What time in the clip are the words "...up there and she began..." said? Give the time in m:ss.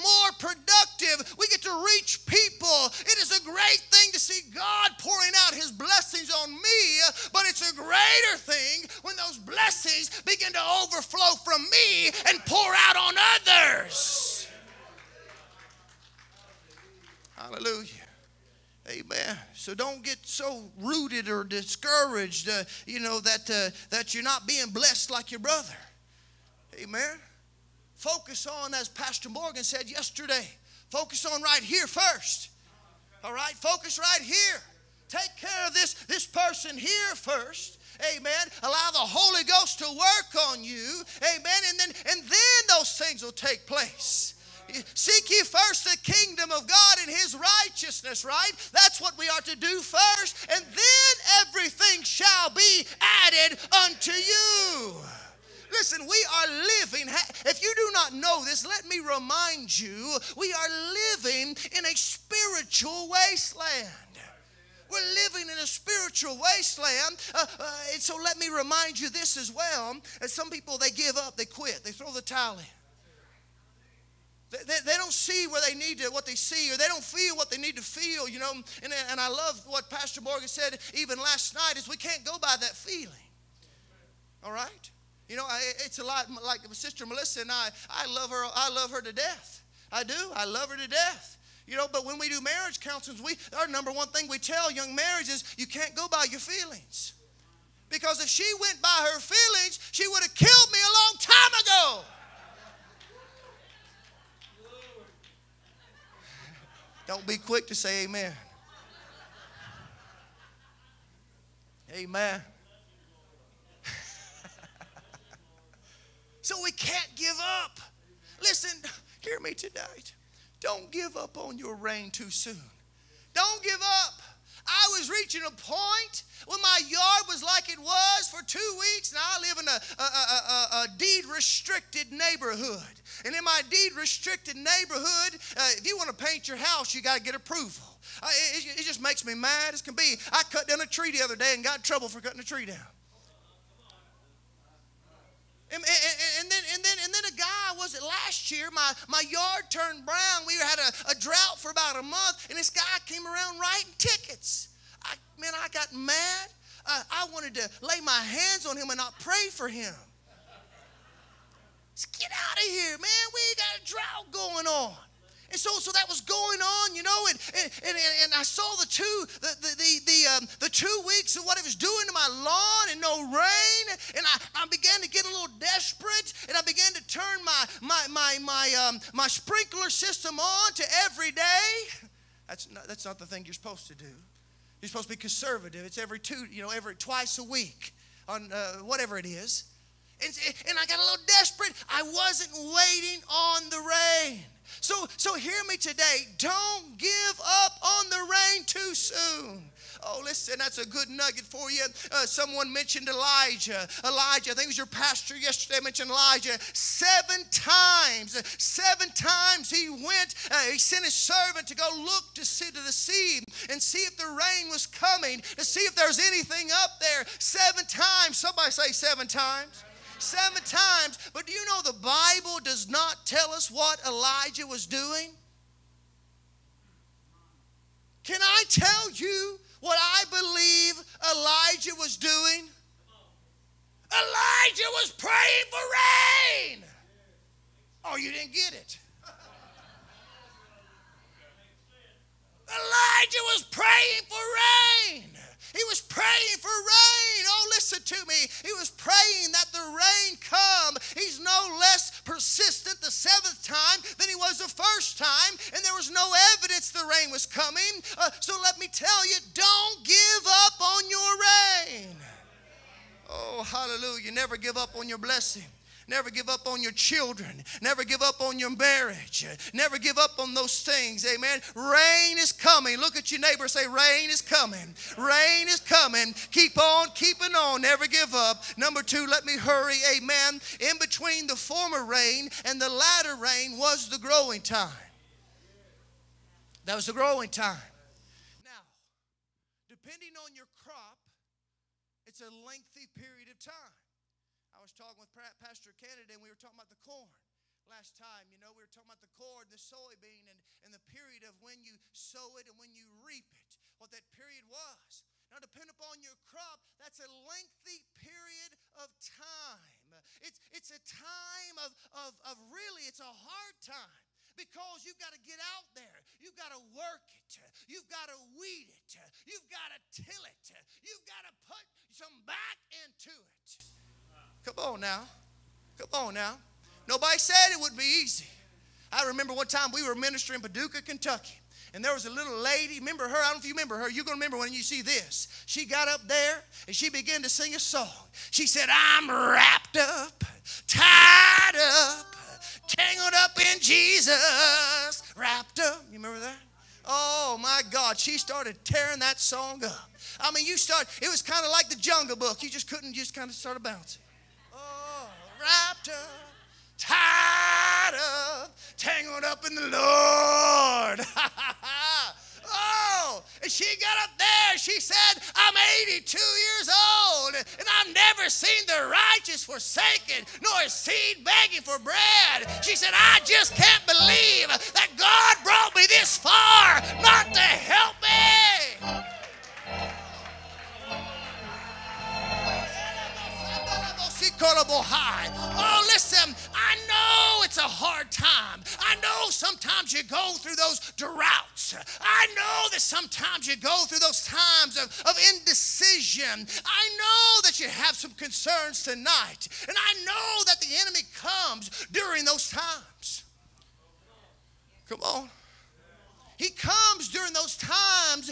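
5:36.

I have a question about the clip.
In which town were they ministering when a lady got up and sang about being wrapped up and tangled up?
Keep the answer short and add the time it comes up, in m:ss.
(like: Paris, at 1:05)
Paducah, Kentucky, at 5:30.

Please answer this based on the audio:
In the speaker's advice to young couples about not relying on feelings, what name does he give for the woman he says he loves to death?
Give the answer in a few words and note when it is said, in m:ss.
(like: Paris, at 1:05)
Sister Melissa, at 1:26.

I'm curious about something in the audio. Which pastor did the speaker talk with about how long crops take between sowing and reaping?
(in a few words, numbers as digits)
Pastor Kennedy.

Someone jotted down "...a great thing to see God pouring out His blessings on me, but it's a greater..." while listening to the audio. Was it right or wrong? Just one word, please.
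right.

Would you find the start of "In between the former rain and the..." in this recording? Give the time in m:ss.
4:40.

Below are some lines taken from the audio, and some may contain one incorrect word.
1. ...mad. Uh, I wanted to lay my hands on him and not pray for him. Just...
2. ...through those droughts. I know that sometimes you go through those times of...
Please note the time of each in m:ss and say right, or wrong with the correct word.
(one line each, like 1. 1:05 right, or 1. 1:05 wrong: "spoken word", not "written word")
1. 2:35 right
2. 6:30 right.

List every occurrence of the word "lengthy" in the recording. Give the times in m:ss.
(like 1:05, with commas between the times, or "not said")
4:52, 5:07.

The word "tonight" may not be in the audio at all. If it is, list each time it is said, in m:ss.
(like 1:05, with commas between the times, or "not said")
1:59, 6:39.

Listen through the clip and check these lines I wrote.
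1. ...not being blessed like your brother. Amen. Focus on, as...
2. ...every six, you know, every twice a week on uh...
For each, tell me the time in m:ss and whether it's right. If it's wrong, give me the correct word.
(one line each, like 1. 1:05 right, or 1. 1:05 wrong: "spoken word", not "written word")
1. 0:24 right
2. 3:05 wrong: "two", not "six".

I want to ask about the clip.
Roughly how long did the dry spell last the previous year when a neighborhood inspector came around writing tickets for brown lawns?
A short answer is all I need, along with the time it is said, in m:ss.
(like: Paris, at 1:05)
About a month, at 2:31.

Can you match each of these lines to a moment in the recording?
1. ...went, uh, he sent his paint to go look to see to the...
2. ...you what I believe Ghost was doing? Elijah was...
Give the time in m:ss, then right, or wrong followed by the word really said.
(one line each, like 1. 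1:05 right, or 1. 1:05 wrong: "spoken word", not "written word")
1. 3:29 wrong: "servant", not "paint"
2. 3:49 wrong: "Elijah", not "Ghost".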